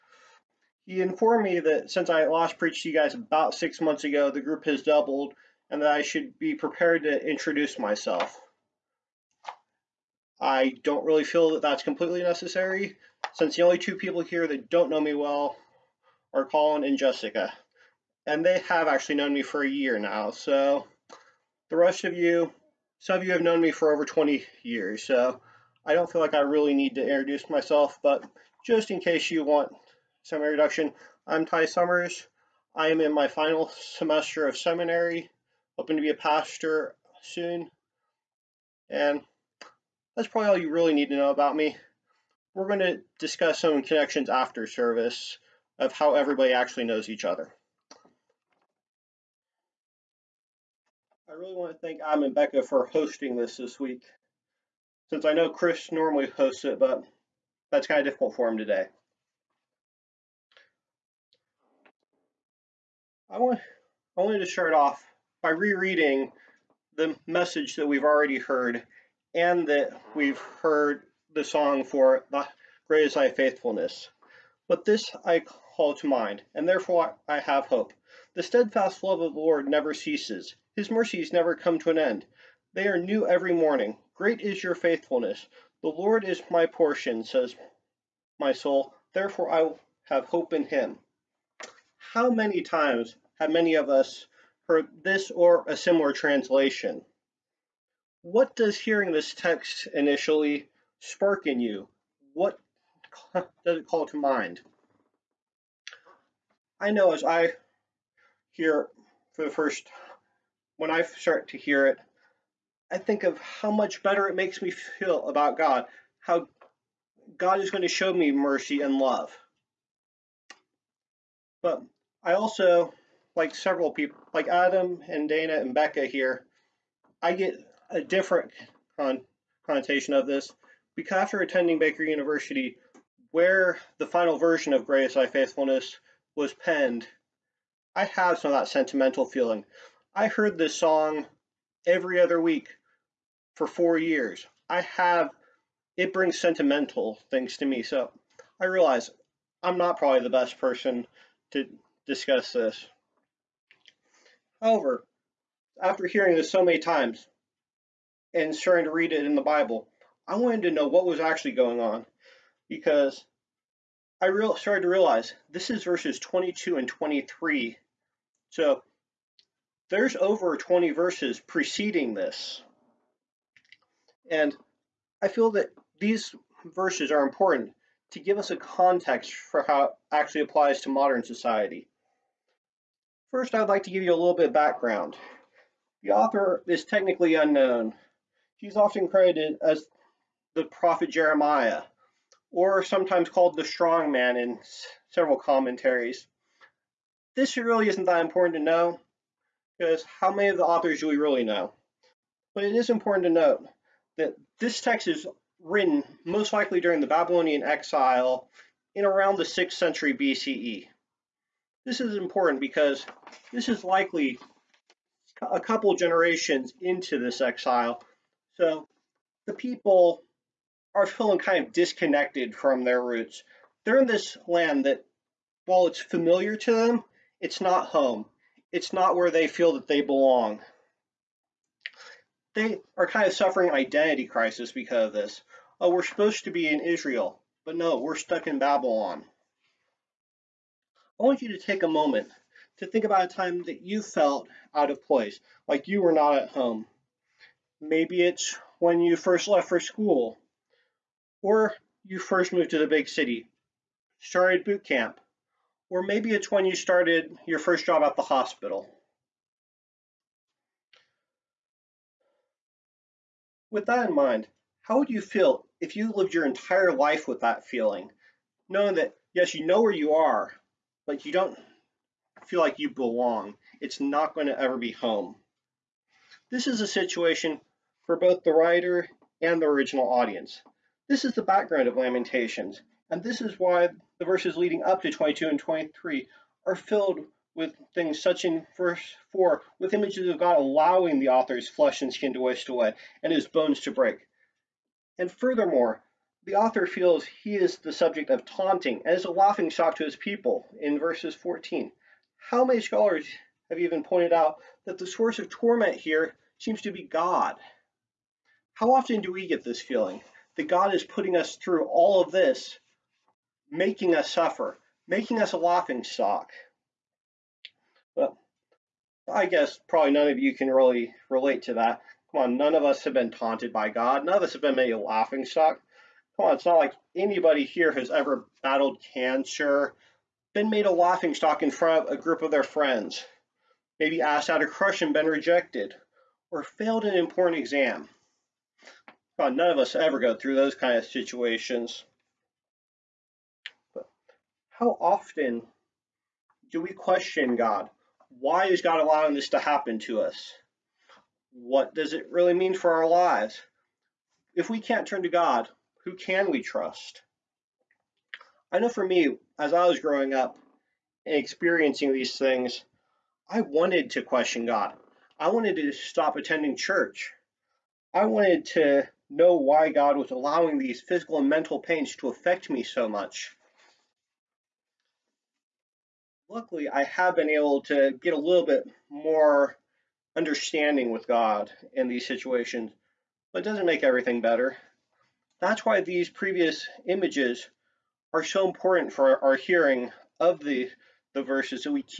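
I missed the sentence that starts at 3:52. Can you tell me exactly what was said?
They are kind of suffering identity crisis because of this.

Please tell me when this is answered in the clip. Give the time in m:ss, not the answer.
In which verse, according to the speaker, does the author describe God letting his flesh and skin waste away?
4:48.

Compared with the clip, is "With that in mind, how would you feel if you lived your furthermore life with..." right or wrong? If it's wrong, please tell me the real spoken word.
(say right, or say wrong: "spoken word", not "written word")
wrong: "entire", not "furthermore".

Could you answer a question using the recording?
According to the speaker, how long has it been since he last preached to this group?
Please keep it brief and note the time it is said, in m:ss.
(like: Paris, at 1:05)
6 months, at 0:03.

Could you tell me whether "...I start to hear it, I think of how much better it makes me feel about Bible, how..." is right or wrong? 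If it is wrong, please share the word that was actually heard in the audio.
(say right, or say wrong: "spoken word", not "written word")
wrong: "God", not "Bible".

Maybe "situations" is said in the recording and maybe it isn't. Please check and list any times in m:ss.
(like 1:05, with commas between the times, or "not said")
4:36, 5:41, 6:22.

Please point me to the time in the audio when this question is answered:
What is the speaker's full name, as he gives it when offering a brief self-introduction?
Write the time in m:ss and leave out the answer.
0:31.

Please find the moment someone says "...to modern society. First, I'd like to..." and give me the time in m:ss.
3:00.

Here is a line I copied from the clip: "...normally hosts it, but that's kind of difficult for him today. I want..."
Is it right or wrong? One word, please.
right.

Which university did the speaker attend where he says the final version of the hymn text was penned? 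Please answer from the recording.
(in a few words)
Baker University.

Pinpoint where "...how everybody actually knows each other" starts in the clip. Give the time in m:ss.
0:45.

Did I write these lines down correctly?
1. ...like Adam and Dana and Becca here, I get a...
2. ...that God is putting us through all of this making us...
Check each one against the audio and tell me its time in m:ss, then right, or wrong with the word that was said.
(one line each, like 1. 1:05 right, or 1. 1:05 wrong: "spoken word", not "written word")
1. 2:04 right
2. 5:10 right.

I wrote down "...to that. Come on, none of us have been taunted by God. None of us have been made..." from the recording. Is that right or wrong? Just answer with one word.
right.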